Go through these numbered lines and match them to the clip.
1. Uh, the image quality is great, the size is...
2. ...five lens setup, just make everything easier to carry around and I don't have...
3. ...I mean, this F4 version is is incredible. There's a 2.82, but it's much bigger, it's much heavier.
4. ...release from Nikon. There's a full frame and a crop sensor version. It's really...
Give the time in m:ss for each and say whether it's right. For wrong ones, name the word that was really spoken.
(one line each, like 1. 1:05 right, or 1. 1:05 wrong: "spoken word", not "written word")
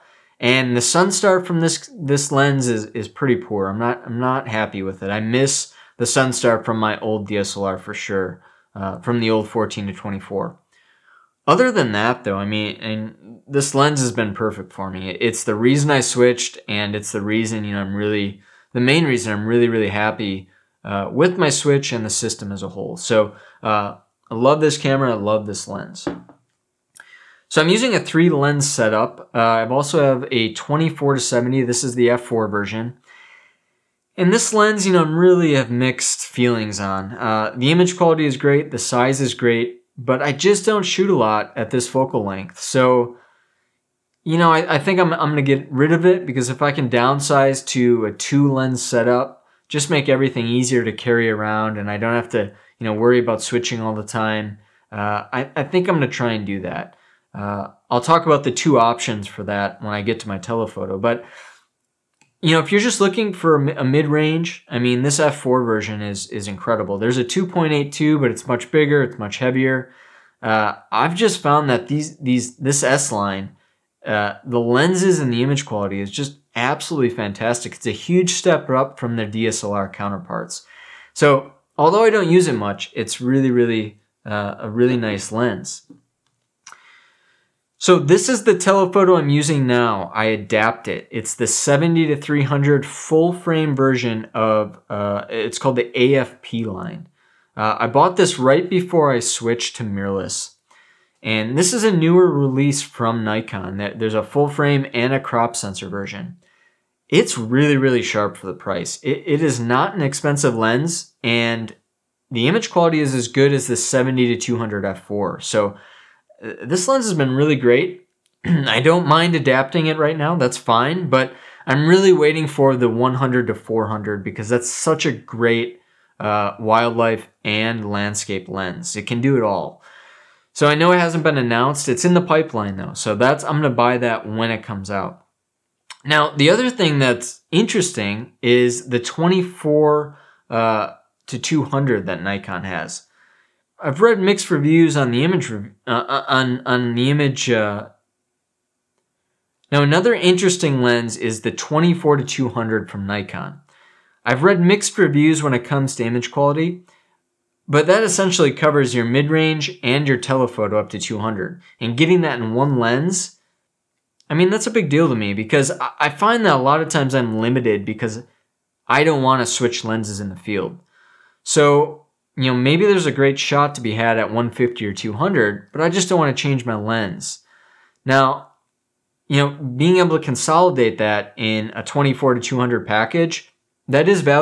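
1. 0:37 right
2. 0:48 wrong: "two", not "five"
3. 1:04 right
4. 1:42 right.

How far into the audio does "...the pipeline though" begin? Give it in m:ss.
2:12.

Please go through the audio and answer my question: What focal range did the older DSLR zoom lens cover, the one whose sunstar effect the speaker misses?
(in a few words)
14 to 24.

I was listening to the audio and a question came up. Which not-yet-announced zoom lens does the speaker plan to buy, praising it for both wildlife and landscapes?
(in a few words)
100 to 400.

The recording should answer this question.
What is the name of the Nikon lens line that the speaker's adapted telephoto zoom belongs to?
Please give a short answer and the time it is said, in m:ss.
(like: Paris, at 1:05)
AF-P, at 1:36.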